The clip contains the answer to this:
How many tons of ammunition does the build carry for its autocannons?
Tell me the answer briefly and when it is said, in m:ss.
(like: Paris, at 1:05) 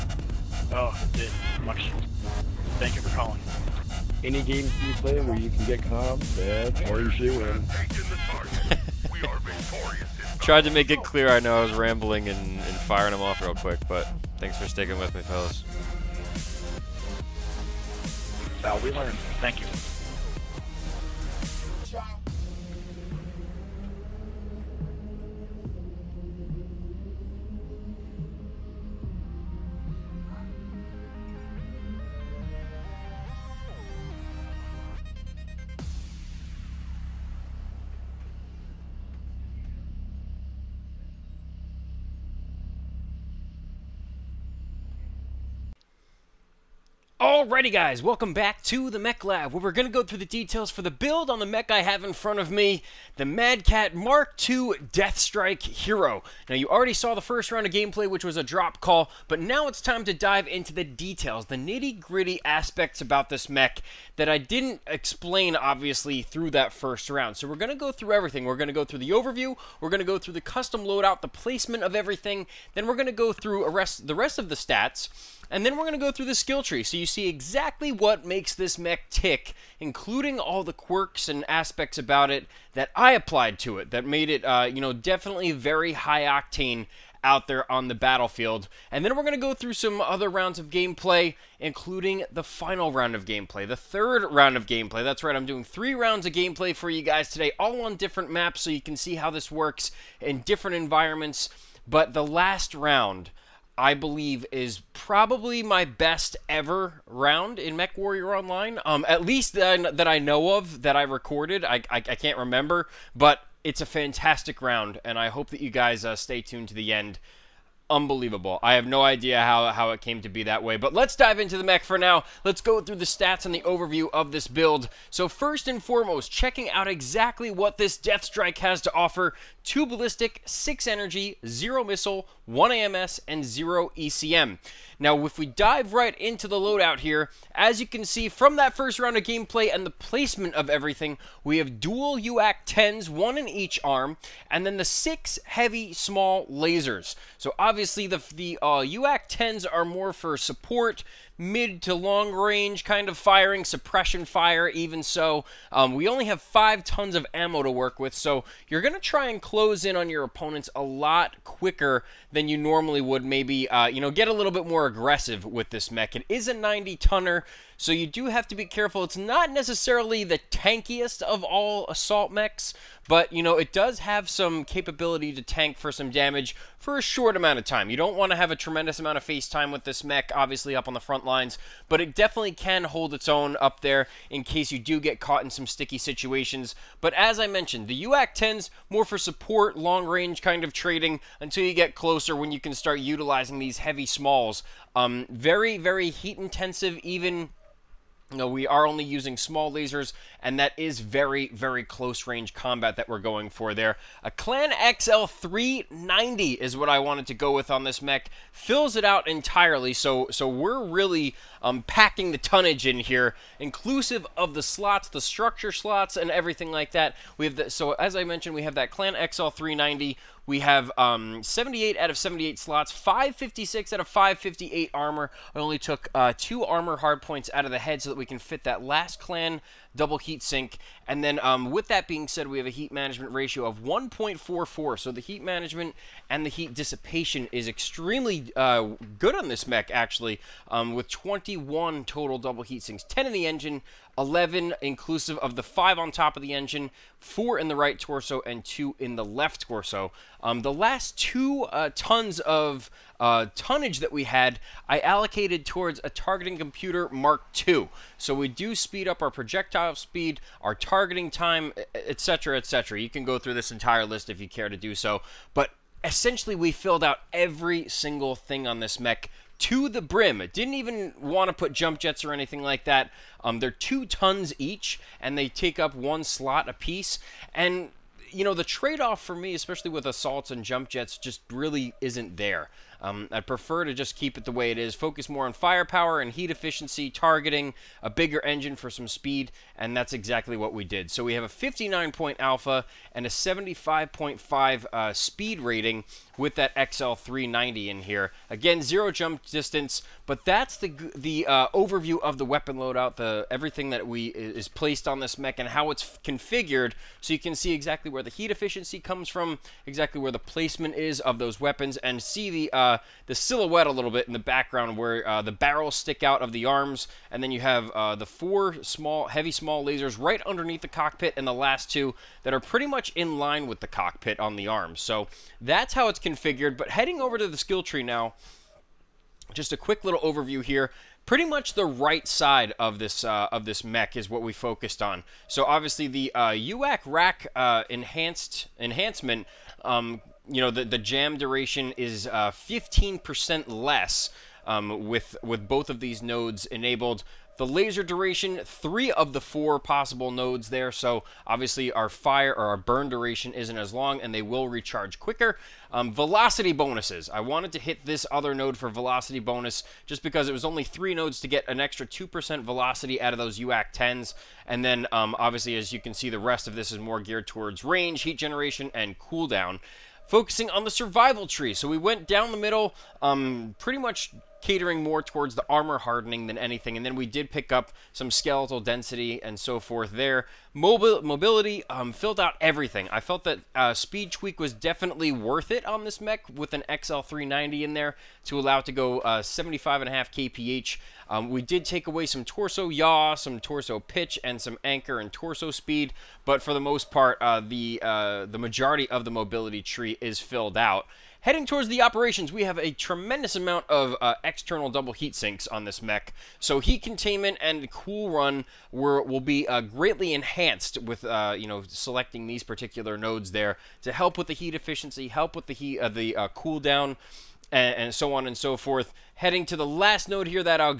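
5, at 2:36.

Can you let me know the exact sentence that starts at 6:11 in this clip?
So we went down the middle, um, pretty much catering more towards the armor hardening than anything.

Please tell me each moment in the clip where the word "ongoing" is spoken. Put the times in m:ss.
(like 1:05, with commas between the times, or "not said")
not said.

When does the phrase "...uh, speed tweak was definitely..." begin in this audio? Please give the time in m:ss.
6:23.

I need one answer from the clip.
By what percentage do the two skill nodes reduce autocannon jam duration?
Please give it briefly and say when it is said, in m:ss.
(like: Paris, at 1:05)
15%, at 5:42.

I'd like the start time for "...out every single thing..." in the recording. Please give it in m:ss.
4:27.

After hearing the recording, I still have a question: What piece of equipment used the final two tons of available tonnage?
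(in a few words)
Targeting Computer Mark II.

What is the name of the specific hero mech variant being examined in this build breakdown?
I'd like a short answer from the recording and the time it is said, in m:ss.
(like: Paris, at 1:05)
Deathstrike, at 0:54.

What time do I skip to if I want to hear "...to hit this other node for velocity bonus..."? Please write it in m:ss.
5:57.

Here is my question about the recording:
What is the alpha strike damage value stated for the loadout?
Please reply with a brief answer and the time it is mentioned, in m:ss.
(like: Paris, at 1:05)
59, at 4:51.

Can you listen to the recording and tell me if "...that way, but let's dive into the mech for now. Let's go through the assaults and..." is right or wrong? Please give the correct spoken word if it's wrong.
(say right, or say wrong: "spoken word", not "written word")
wrong: "stats", not "assaults".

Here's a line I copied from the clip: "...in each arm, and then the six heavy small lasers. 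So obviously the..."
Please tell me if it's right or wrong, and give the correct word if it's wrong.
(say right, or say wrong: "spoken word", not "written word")
right.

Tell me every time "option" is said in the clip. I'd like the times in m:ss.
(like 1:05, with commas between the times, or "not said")
not said.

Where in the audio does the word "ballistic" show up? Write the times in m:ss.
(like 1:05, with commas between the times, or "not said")
2:09.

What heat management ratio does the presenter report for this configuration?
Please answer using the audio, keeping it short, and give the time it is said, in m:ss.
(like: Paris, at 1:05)
1.44, at 3:53.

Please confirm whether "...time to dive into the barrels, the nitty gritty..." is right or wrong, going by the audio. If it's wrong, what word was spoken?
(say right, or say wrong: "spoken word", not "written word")
wrong: "details", not "barrels".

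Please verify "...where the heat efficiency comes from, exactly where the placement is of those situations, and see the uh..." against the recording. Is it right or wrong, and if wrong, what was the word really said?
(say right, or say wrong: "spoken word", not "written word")
wrong: "weapons", not "situations".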